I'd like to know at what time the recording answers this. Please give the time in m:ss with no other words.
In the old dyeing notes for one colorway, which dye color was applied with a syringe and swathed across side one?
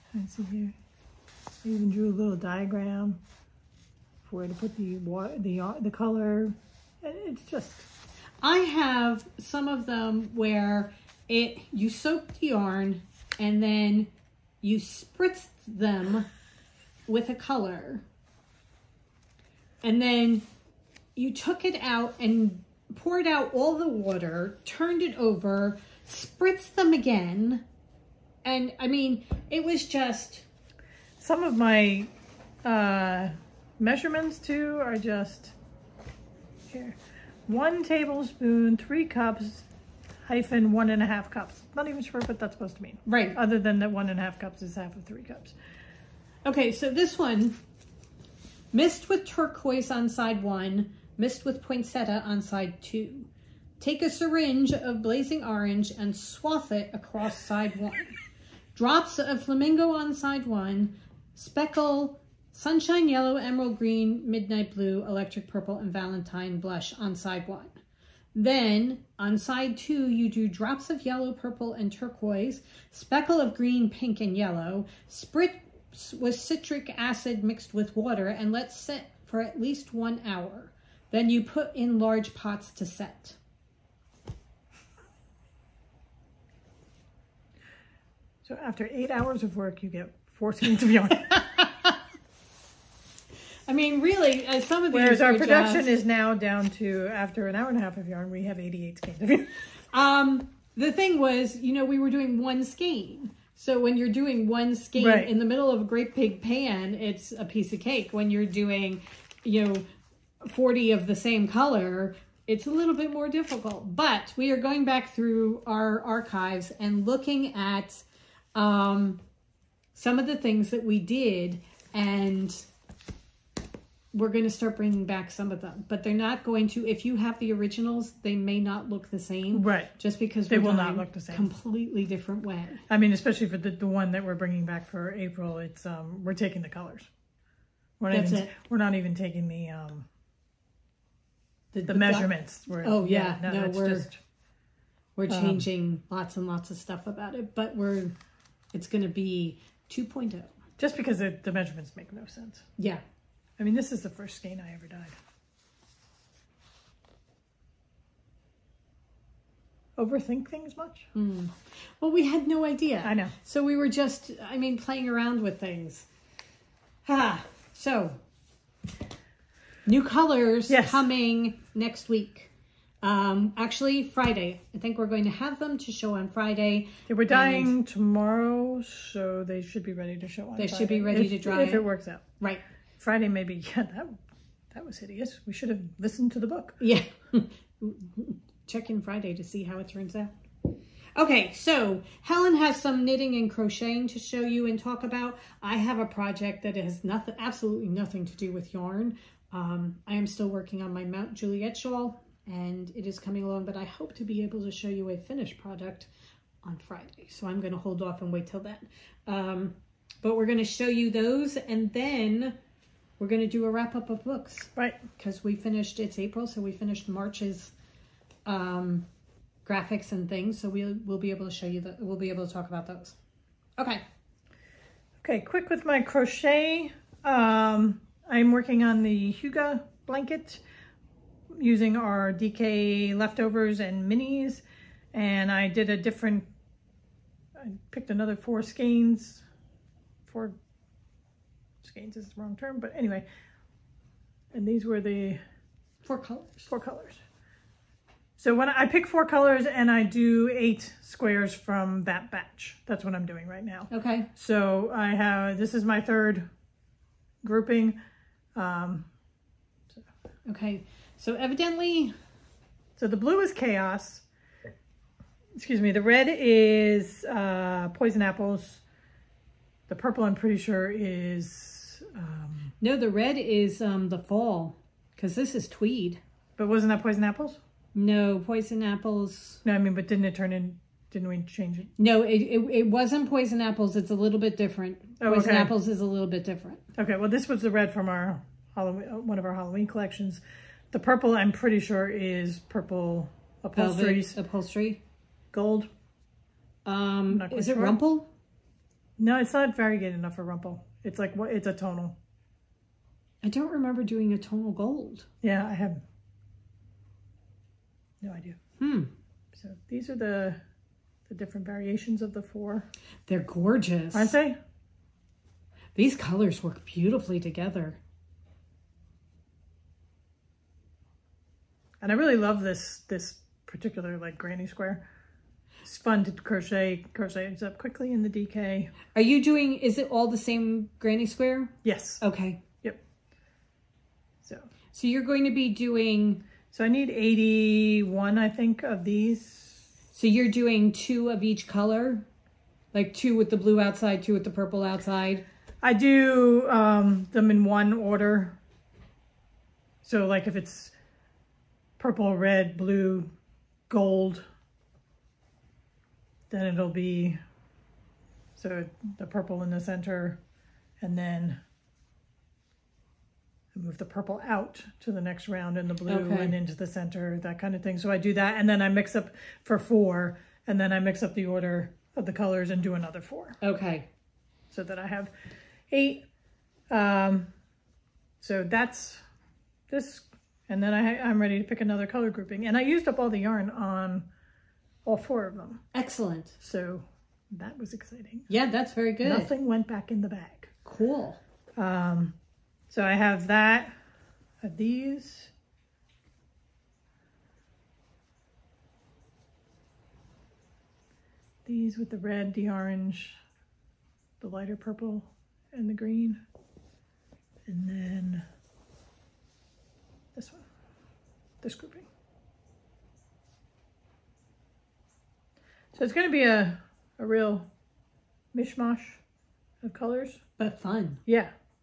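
0:55.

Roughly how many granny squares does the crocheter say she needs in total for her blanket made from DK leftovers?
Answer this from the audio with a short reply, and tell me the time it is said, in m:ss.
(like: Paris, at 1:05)
81, at 5:37.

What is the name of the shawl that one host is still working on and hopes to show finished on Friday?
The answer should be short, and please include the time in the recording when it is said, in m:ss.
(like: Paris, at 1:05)
Mount Juliet shawl, at 3:21.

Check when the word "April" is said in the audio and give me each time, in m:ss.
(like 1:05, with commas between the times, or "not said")
2:15, 3:36.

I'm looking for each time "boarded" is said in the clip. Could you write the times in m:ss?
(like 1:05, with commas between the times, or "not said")
not said.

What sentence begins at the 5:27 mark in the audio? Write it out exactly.
Crochet ends up quickly in the DK.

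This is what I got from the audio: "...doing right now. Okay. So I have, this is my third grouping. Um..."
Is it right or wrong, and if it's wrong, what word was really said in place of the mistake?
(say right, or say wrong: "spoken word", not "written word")
right.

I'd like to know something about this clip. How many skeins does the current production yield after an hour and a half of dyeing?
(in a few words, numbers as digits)
88.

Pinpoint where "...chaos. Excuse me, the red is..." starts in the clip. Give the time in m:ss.
4:23.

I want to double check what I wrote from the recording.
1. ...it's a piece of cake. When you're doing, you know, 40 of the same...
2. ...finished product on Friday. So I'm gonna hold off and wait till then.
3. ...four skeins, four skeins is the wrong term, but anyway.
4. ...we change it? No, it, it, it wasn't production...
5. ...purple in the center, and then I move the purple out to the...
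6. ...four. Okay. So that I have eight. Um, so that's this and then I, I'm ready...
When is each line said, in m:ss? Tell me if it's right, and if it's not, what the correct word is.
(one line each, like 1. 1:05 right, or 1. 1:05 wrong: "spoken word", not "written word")
1. 1:46 right
2. 3:25 right
3. 3:58 right
4. 4:41 wrong: "poison", not "production"
5. 5:59 right
6. 6:13 right.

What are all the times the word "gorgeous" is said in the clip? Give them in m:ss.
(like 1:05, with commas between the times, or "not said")
5:13.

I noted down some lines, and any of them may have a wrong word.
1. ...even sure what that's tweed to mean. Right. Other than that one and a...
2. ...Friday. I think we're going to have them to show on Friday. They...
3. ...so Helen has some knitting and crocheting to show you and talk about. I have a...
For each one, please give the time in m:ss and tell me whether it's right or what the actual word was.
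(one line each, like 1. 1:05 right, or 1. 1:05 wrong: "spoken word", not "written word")
1. 0:41 wrong: "supposed", not "tweed"
2. 2:54 right
3. 3:11 right.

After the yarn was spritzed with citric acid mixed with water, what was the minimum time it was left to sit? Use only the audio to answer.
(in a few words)
1 hour.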